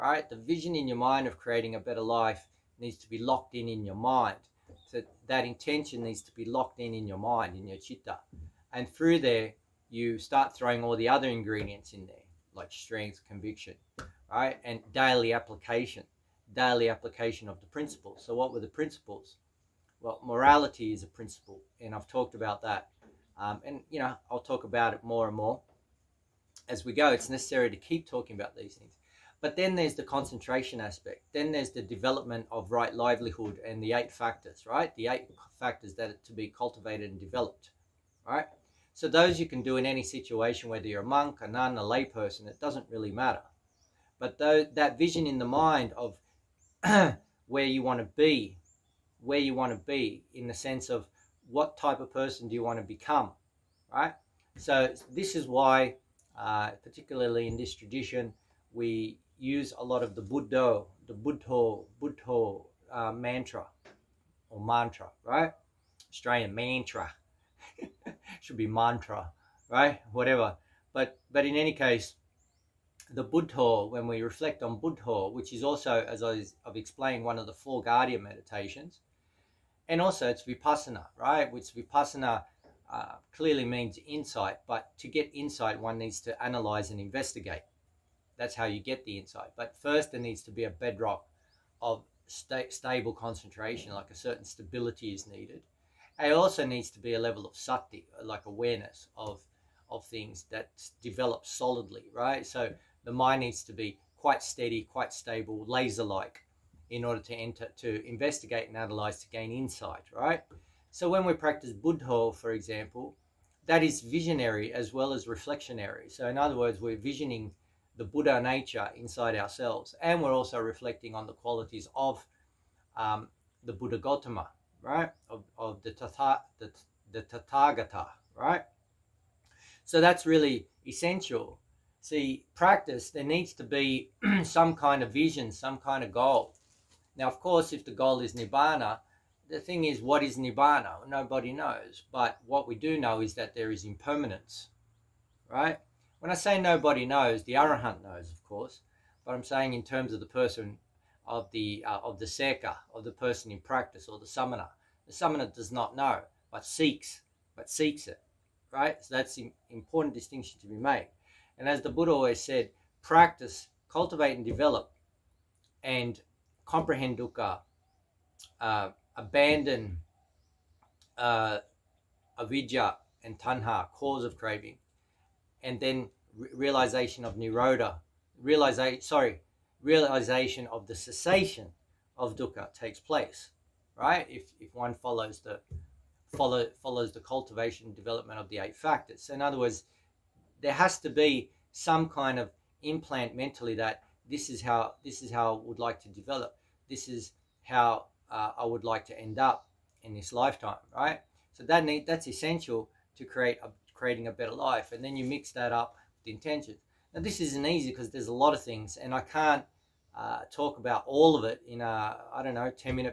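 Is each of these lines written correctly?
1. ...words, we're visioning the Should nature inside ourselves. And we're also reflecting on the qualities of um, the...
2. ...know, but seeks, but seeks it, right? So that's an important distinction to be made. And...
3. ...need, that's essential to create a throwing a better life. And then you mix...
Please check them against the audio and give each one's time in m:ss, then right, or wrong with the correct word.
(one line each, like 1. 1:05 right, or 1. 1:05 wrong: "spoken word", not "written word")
1. 1:56 wrong: "Buddha", not "Should"
2. 2:35 right
3. 3:21 wrong: "creating", not "throwing".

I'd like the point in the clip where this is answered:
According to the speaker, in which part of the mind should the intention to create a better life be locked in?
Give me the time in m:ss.
0:07.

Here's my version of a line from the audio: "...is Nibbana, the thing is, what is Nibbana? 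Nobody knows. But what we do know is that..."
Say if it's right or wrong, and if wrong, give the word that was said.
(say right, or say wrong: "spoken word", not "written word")
right.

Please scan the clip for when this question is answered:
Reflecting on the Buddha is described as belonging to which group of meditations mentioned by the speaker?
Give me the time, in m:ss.
1:17.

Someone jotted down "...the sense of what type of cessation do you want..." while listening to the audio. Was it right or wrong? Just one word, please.
wrong.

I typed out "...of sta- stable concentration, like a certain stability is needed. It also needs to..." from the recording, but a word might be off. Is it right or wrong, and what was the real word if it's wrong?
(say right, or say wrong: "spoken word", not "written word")
right.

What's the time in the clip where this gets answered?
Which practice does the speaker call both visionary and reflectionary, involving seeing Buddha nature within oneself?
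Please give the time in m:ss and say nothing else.
1:51.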